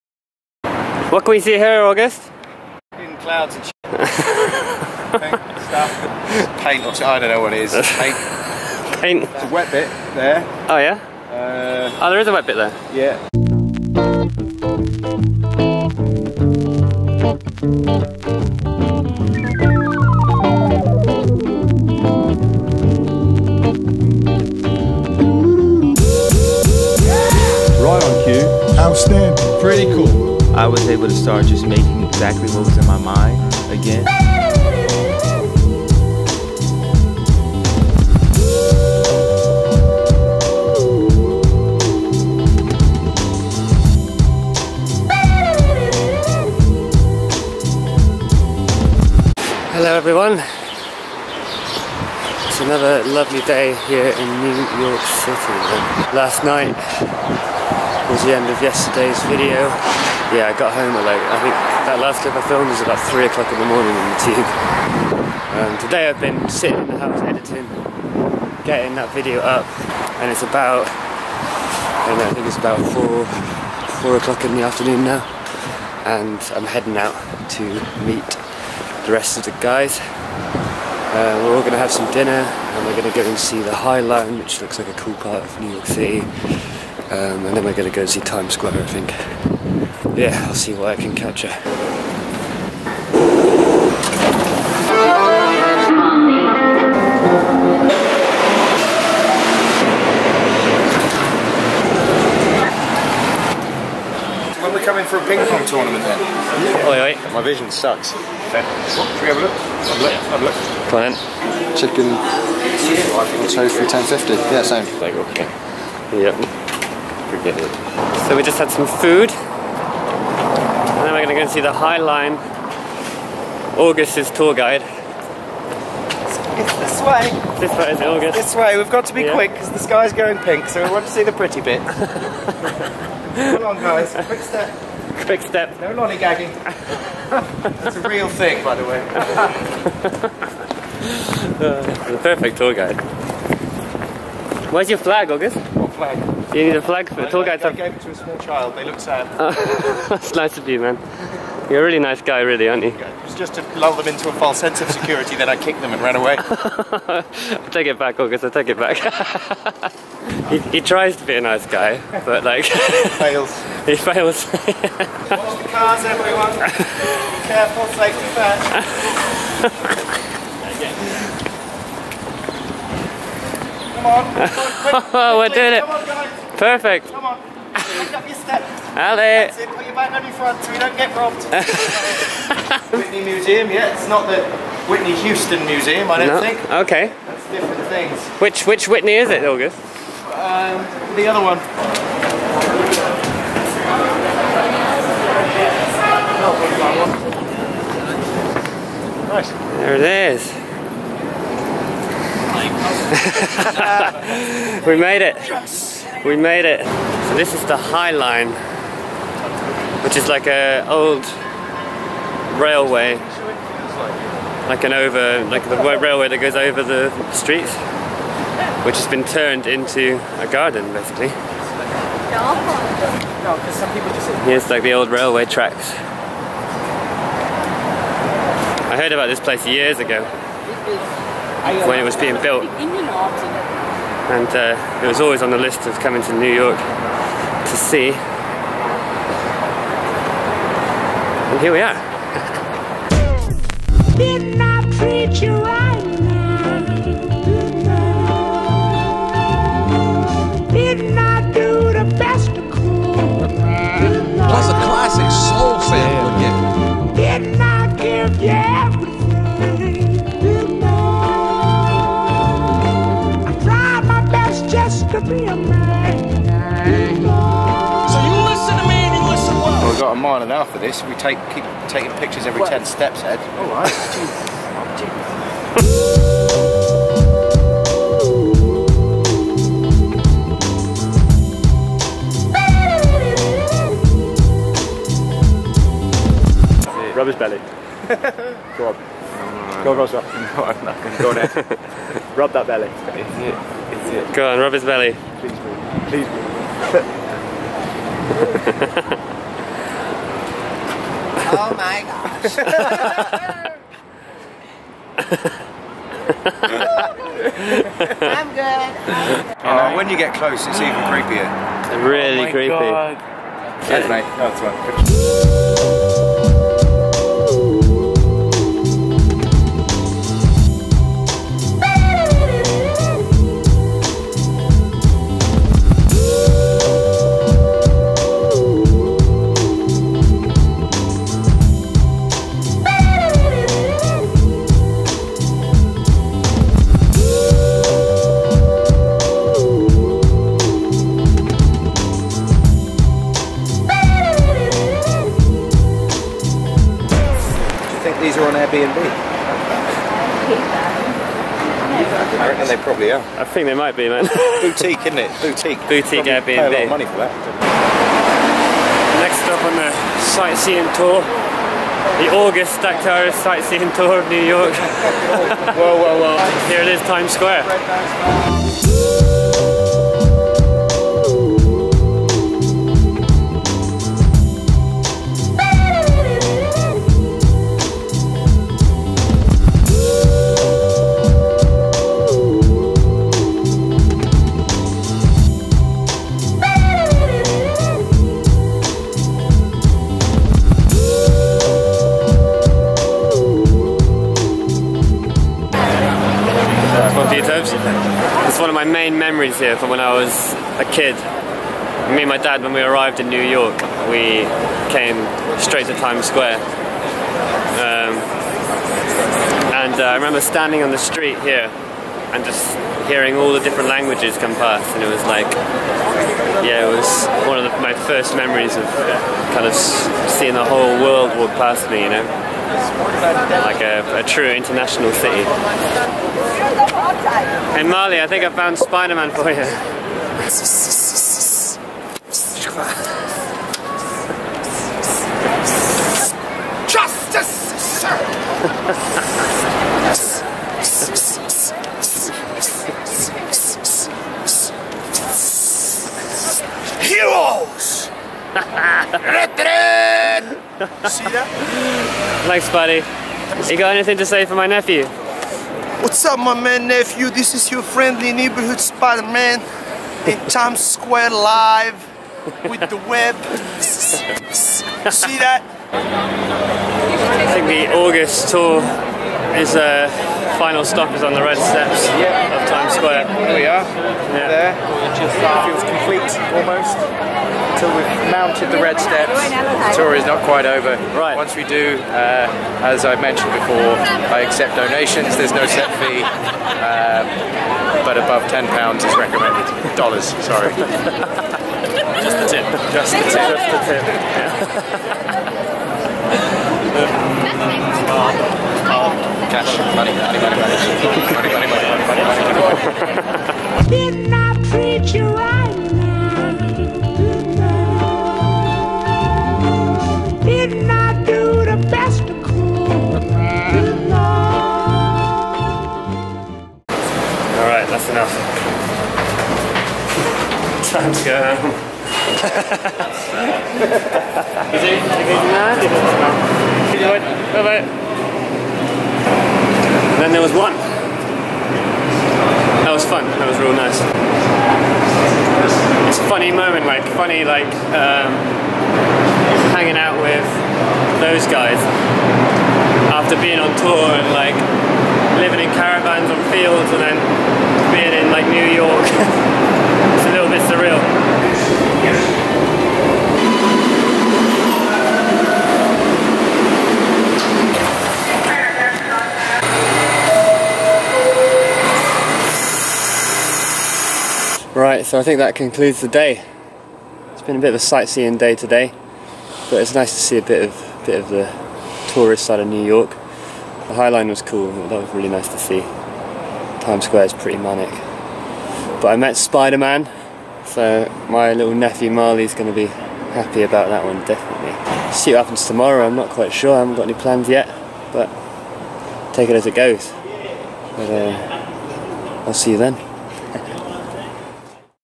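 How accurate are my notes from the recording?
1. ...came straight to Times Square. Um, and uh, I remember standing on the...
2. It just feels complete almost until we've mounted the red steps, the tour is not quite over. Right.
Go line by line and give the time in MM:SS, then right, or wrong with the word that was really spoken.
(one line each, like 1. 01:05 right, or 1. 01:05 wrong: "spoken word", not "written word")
1. 06:44 right
2. 07:55 right.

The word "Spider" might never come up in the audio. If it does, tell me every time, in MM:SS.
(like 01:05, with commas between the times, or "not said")
07:08, 07:38, 09:39.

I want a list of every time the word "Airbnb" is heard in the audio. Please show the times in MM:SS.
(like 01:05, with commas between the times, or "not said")
05:48, 05:56.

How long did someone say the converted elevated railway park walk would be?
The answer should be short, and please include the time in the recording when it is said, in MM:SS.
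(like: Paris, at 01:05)
A mile and a half, at 04:30.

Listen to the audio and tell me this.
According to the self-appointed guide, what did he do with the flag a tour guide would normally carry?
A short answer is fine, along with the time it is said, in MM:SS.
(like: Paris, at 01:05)
Gave it to a small child, at 02:27.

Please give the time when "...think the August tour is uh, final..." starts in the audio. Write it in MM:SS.
07:47.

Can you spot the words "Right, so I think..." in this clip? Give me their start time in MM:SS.
09:24.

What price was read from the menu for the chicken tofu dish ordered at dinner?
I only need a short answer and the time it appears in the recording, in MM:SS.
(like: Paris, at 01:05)
1050, at 01:53.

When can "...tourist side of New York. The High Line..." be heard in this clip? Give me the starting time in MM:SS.
09:32.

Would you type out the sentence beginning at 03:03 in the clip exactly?
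It's not the Whitney Houston Museum, I don't no.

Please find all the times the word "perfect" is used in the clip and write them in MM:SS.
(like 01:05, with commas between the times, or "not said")
02:22, 02:56.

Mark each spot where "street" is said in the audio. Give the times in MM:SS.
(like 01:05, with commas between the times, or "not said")
03:37, 06:50.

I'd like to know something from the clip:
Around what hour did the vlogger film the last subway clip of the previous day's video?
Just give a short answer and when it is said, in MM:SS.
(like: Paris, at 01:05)
3 o'clock, at 01:03.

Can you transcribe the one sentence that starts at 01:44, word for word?
When we're coming for a ping pong tournament then?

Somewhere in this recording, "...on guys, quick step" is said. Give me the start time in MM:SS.
02:13.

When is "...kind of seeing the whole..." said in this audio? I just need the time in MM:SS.
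06:59.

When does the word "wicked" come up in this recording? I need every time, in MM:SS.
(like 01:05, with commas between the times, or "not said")
not said.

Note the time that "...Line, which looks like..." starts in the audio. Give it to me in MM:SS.
01:23.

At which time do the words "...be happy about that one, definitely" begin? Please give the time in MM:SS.
09:42.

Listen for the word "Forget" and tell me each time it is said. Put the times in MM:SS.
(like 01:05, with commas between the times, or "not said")
01:57.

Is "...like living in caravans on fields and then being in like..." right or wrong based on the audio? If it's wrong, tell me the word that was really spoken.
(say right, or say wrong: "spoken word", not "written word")
right.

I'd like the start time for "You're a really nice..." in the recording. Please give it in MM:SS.
02:31.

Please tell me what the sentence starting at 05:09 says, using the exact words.
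Oh, when you get close, it's even creepier.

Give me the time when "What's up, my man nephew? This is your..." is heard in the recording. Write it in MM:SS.
07:36.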